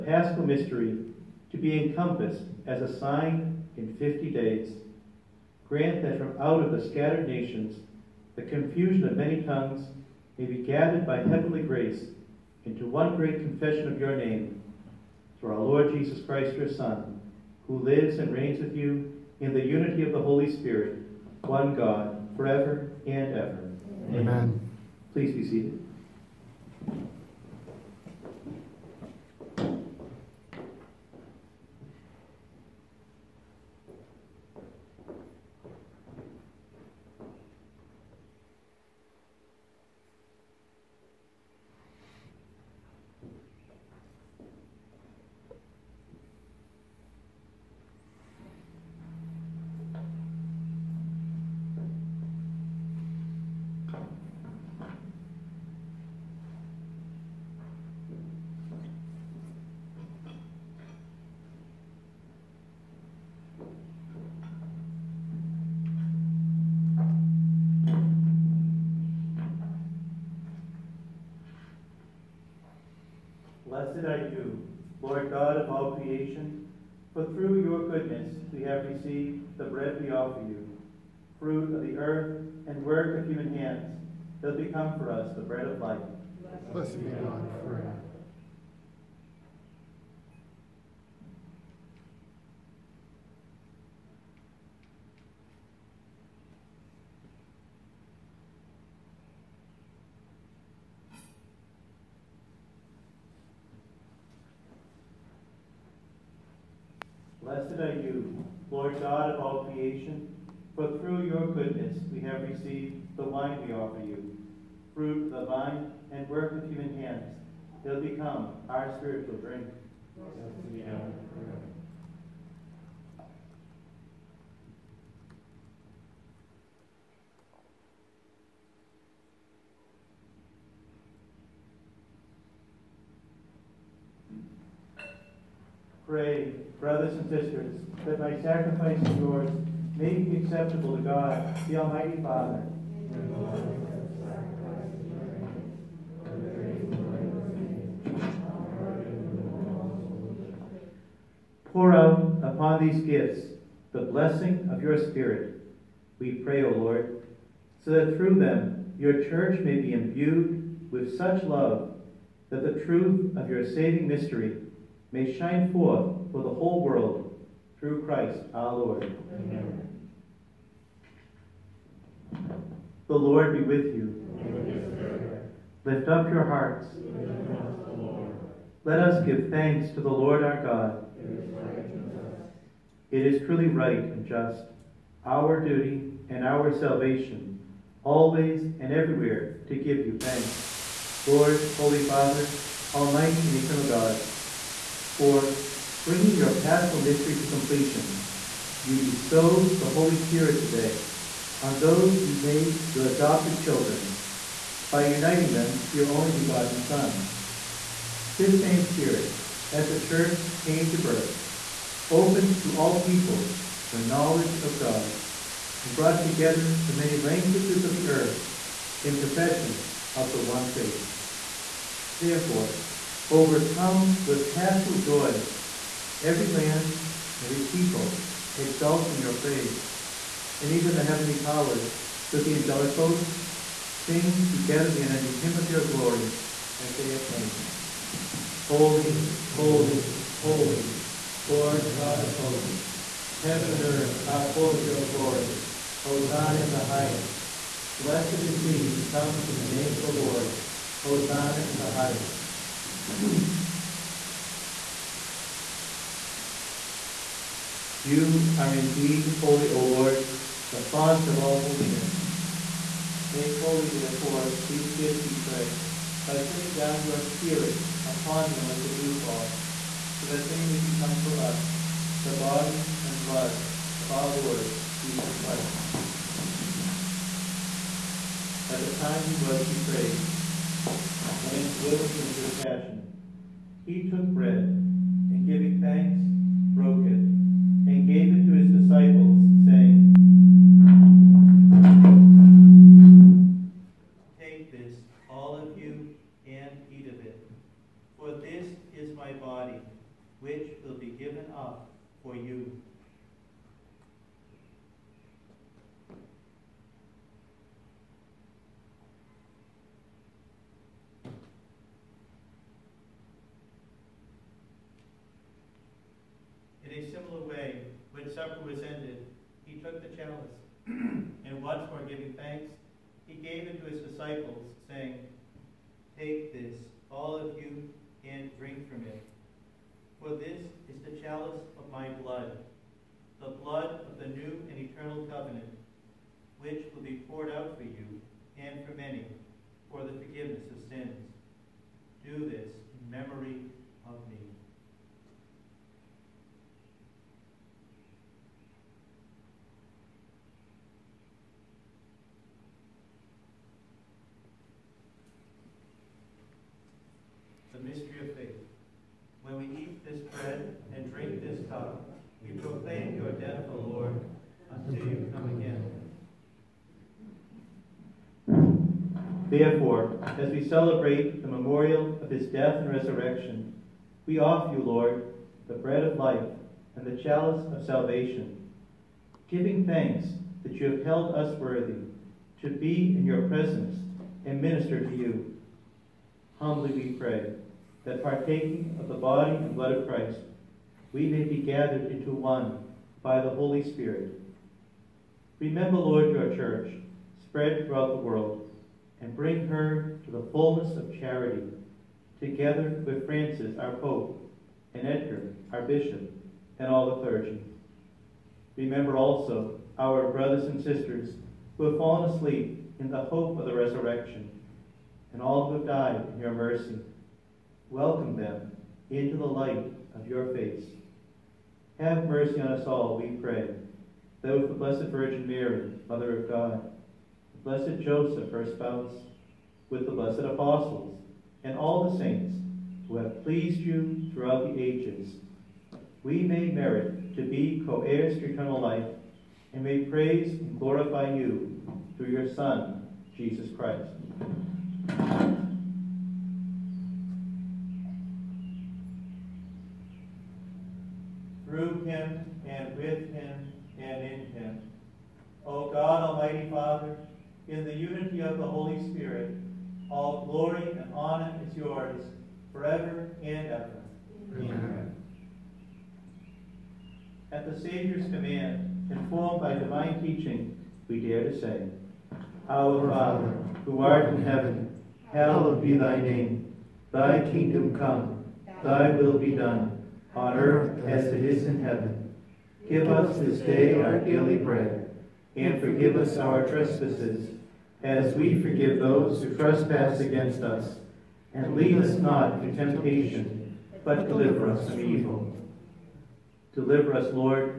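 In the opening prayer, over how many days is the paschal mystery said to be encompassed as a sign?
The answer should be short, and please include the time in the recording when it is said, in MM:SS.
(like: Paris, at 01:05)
50, at 00:03.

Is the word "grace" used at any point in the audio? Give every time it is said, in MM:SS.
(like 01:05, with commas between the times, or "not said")
00:11.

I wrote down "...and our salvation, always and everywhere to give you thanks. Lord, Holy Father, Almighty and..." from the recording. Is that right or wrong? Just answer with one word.
right.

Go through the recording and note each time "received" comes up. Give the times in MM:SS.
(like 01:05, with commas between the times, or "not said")
01:18, 01:52.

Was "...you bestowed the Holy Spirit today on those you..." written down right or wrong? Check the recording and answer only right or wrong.
right.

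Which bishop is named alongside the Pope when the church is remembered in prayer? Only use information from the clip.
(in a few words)
Edgar.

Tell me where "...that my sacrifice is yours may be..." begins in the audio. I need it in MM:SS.
02:18.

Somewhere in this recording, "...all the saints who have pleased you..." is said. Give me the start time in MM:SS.
07:11.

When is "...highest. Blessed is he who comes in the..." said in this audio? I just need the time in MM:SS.
04:06.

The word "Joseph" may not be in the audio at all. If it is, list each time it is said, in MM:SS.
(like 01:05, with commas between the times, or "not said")
07:08.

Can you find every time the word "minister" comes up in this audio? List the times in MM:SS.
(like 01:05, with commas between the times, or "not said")
06:24.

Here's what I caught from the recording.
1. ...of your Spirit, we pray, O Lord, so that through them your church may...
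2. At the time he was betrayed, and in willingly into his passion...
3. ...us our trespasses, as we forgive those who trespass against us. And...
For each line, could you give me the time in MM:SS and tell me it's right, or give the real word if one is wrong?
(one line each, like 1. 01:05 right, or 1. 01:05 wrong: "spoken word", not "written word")
1. 02:34 right
2. 04:38 right
3. 08:06 right.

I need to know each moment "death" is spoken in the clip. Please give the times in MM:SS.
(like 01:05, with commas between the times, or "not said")
06:03, 06:12.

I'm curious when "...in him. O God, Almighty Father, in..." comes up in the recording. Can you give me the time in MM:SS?
07:34.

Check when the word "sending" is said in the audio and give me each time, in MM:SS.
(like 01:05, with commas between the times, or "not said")
04:26.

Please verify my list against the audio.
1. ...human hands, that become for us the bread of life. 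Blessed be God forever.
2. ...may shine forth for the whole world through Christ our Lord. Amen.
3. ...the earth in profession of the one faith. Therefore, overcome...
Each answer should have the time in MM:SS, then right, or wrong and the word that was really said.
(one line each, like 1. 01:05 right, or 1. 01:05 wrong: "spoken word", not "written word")
1. 01:23 right
2. 02:45 right
3. 03:37 right.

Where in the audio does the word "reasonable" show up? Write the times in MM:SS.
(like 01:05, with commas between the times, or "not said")
not said.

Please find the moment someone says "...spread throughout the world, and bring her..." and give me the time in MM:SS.
06:37.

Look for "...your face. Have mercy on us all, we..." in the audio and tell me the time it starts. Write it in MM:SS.
07:00.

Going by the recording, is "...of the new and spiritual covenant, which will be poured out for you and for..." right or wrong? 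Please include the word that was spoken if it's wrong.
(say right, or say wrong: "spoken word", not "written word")
wrong: "eternal", not "spiritual".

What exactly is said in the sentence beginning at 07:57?
Thy kingdom come, thy will be done on earth as it is in heaven.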